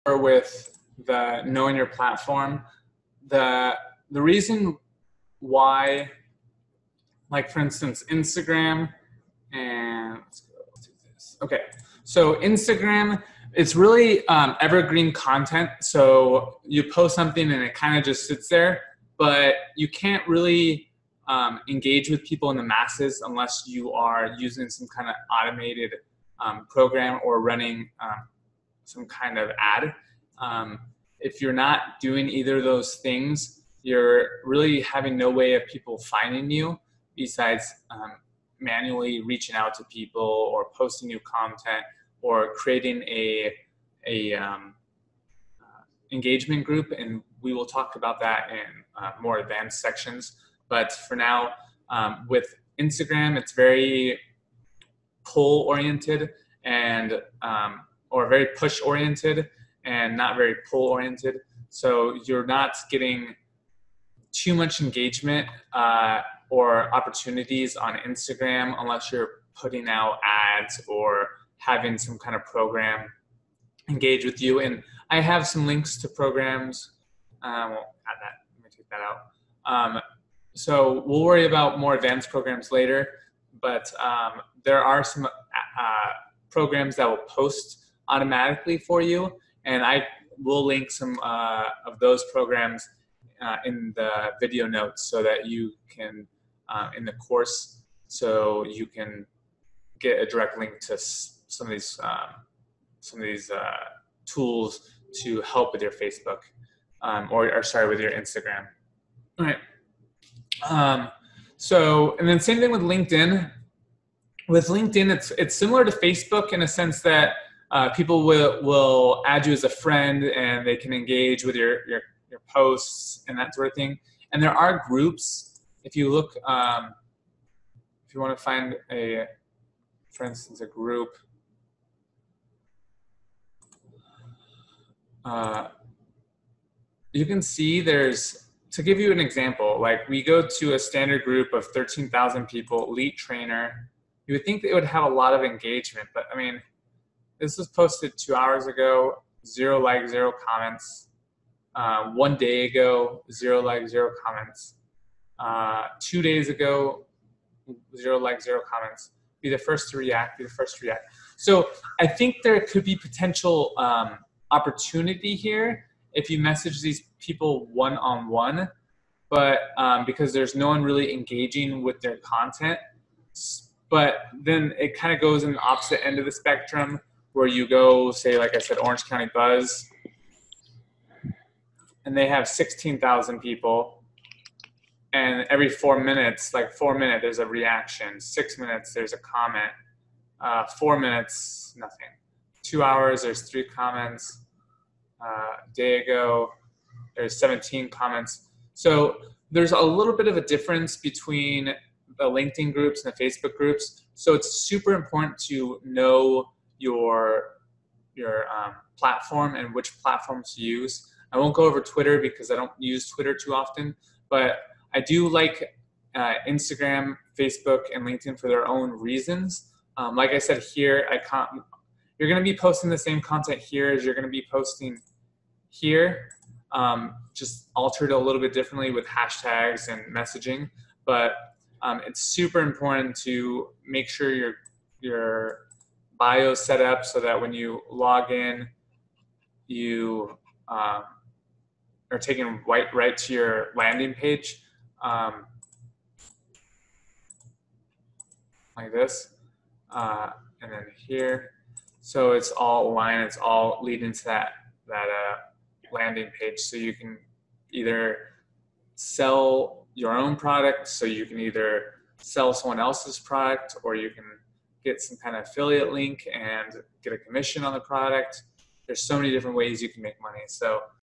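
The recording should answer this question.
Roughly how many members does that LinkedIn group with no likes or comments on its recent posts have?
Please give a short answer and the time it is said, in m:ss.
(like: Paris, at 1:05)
13,000, at 2:21.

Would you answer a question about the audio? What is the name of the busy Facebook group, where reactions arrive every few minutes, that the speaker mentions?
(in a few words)
Orange County Buzz.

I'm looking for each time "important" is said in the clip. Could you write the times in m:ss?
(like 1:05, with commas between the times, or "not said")
3:24, 3:52.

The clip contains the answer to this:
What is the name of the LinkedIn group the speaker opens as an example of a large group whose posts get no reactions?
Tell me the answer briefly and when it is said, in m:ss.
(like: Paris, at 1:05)
Elite Trainer, at 2:22.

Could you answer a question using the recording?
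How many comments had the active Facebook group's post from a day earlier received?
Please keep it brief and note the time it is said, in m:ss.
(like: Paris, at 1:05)
17, at 3:17.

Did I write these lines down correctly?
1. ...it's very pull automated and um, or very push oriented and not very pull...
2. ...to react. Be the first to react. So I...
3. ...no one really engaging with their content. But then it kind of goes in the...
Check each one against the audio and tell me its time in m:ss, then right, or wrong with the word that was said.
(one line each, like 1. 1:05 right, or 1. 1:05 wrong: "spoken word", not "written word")
1. 0:53 wrong: "oriented", not "automated"
2. 2:39 right
3. 2:50 right.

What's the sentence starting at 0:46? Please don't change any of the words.
And we will talk about that in uh, more advanced sections.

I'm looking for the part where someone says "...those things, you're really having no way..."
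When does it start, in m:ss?
0:32.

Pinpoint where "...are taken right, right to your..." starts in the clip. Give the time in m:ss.
4:02.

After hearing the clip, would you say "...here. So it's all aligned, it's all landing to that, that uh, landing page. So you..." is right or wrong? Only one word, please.
wrong.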